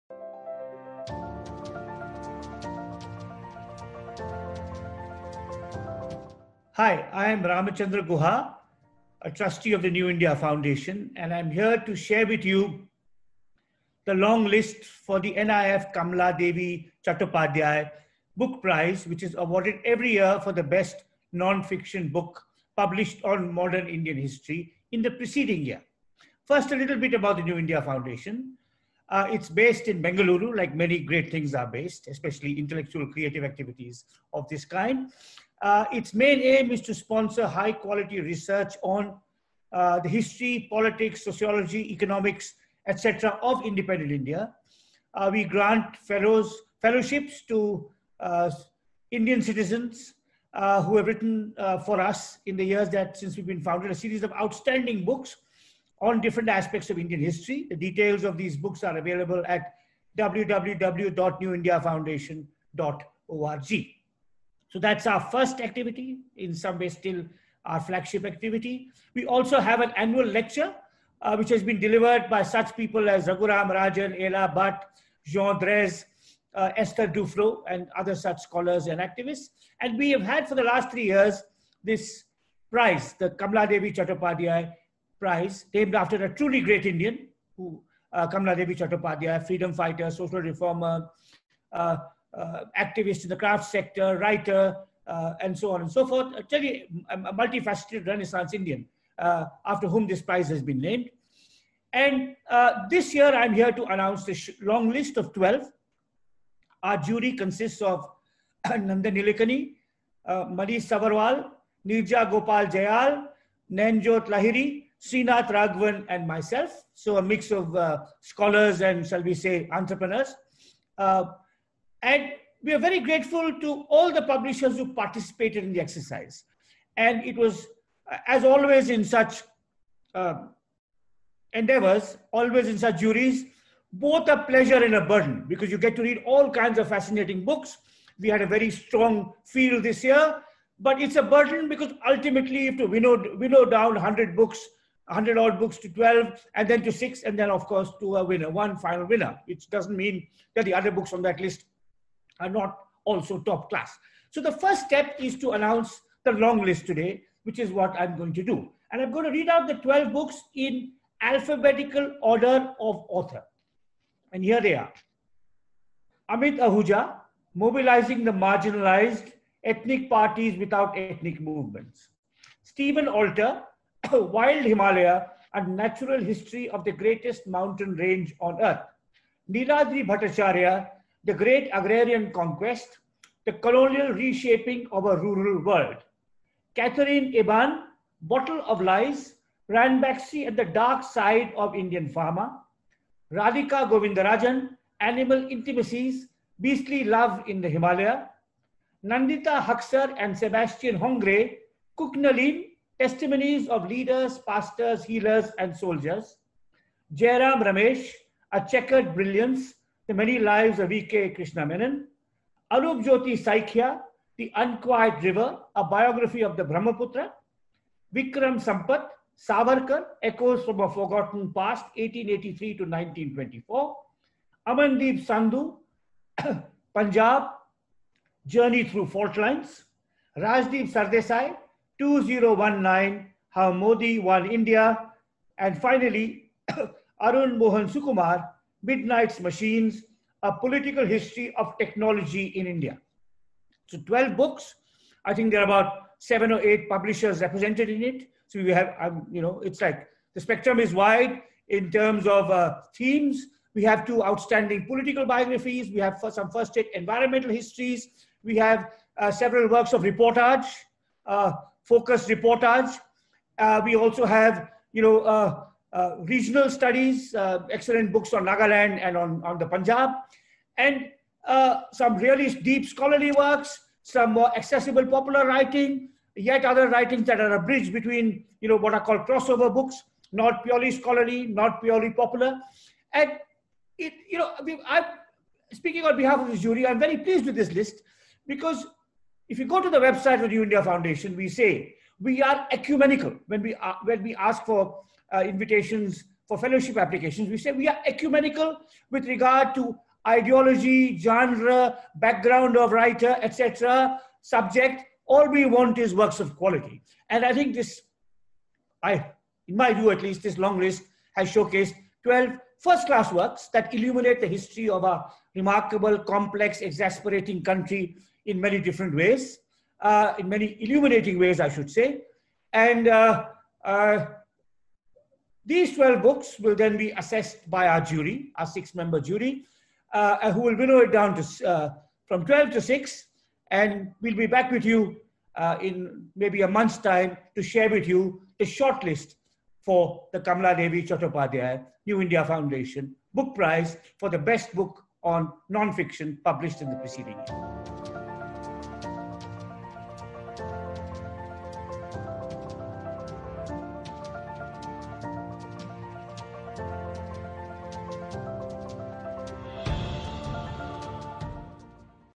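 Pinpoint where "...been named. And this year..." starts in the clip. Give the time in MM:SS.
01:40.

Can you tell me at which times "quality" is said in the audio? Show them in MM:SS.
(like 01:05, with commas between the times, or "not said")
00:37, 05:06.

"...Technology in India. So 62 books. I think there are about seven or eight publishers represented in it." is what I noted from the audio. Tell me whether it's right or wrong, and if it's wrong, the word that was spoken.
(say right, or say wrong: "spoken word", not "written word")
wrong: "12", not "62".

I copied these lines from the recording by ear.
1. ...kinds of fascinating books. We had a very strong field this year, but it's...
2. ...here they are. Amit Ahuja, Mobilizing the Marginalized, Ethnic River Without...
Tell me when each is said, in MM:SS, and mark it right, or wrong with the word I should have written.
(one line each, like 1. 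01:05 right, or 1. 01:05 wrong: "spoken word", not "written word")
1. 02:16 right
2. 02:44 wrong: "Parties", not "River".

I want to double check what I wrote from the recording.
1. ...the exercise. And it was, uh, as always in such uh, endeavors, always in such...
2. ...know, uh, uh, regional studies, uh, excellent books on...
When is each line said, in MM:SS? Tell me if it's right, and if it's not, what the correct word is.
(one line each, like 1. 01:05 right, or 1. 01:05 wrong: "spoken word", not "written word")
1. 02:05 right
2. 04:25 right.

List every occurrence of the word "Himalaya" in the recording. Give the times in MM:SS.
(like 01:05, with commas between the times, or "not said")
02:54, 03:17.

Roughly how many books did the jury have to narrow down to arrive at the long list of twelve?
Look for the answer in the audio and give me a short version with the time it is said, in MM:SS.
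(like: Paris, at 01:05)
100, at 02:25.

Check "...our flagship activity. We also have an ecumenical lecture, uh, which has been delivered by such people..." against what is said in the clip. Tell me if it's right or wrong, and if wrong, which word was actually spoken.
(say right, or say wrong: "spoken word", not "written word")
wrong: "annual", not "ecumenical".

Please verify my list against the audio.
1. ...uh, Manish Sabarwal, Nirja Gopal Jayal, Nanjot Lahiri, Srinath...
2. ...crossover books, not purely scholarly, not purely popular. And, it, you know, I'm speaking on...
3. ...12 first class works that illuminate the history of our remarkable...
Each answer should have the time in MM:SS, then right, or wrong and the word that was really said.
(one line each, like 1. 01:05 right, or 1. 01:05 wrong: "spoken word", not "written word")
1. 01:50 right
2. 04:39 right
3. 05:12 right.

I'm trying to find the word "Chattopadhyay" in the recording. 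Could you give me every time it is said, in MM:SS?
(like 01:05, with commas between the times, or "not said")
00:17, 01:23, 01:28, 05:41.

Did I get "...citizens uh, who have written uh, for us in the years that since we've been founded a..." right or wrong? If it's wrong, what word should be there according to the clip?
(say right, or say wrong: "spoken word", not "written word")
right.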